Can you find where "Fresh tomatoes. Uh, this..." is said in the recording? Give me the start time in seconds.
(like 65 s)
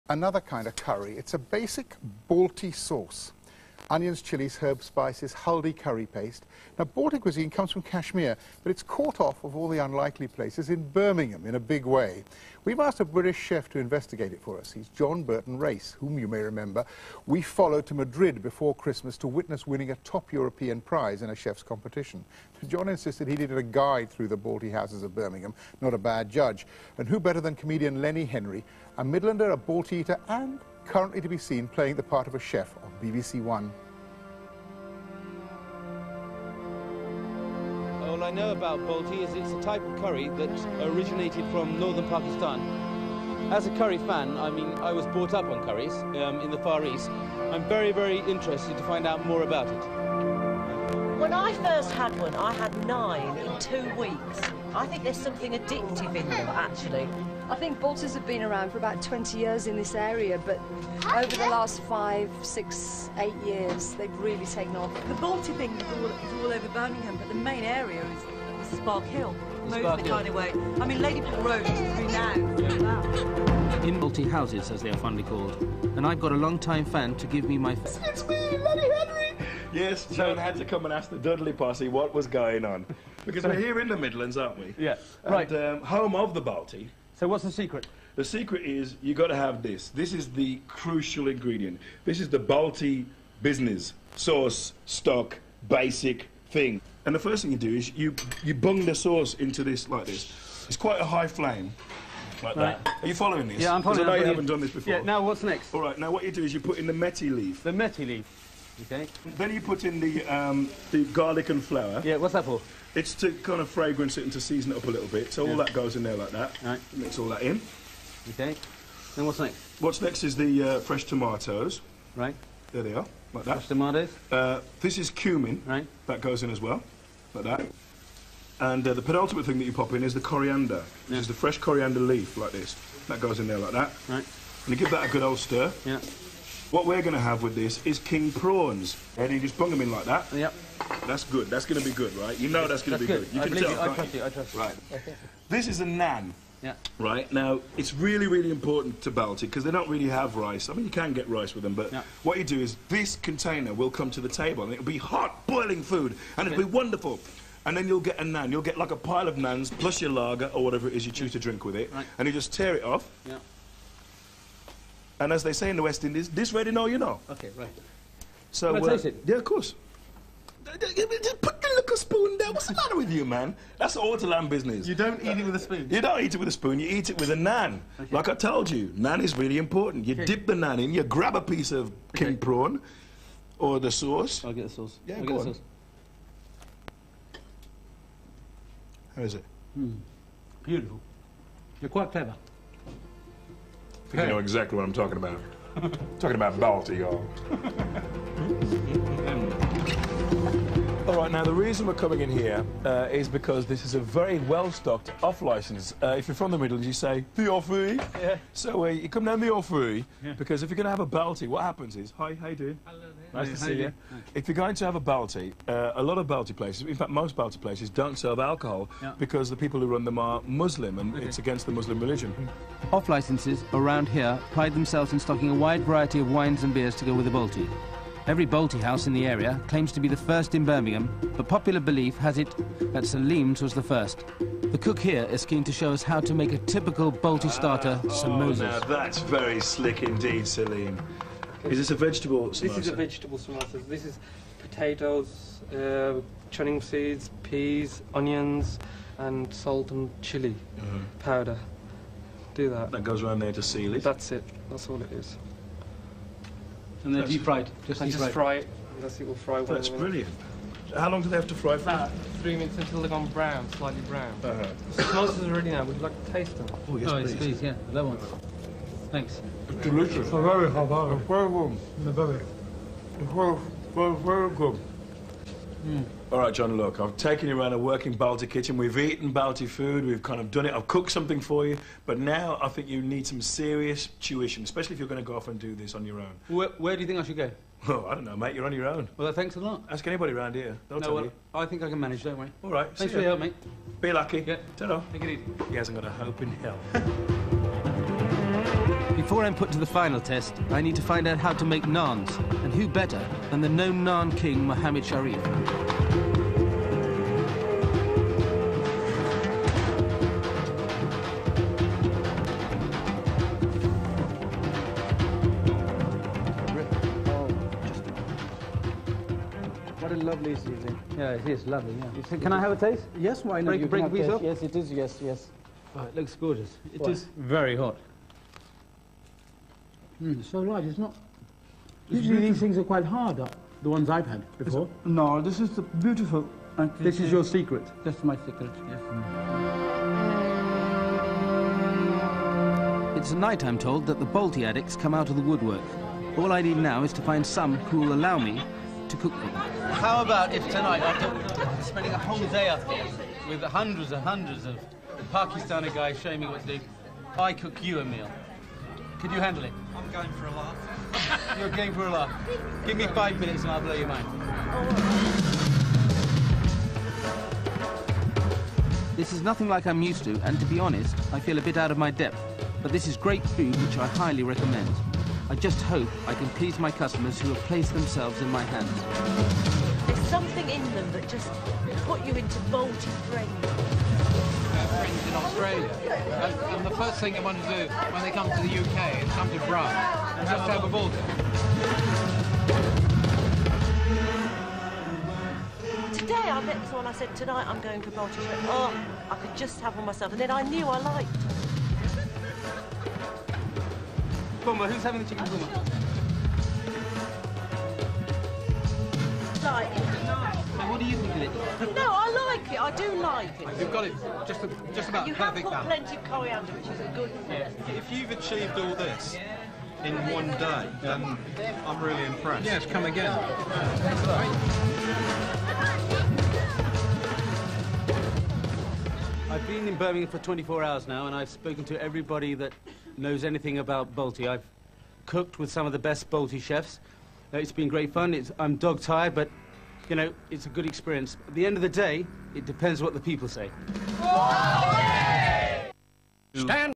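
123 s.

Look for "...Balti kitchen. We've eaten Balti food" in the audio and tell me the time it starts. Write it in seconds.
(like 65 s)
278 s.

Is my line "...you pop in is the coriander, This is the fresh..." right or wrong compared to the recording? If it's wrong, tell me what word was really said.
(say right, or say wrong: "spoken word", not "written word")
right.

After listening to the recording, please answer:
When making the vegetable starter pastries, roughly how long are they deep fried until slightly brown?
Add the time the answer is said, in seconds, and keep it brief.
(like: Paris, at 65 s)
About three minutes, at 261 s.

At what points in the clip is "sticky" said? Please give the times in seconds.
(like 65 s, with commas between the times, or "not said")
not said.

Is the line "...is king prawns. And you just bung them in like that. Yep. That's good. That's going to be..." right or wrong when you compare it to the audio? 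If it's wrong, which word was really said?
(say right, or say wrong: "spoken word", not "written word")
right.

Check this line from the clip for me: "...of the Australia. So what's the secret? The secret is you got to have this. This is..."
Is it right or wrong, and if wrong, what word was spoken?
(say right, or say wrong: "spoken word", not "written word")
wrong: "Balti", not "Australia".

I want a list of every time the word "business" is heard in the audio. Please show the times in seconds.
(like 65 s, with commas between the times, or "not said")
93 s, 174 s.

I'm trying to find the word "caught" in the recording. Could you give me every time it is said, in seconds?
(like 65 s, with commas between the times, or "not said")
8 s.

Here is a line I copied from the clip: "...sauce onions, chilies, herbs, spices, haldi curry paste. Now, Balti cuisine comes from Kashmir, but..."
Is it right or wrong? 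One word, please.
right.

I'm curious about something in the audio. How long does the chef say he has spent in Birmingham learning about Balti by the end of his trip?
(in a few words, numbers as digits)
24 hours.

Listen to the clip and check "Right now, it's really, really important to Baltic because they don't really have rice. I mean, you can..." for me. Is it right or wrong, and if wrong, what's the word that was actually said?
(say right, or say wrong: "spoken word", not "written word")
right.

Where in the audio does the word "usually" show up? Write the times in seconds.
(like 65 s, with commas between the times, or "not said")
332 s.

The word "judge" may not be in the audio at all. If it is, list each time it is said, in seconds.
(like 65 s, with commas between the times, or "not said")
26 s.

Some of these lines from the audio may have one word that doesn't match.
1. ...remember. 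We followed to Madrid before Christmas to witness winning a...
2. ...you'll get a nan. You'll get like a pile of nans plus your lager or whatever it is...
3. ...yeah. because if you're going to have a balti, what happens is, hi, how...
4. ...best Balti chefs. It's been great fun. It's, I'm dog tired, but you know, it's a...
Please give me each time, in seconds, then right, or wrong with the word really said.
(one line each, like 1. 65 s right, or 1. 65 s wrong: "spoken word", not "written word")
1. 16 s right
2. 157 s right
3. 210 s right
4. 435 s right.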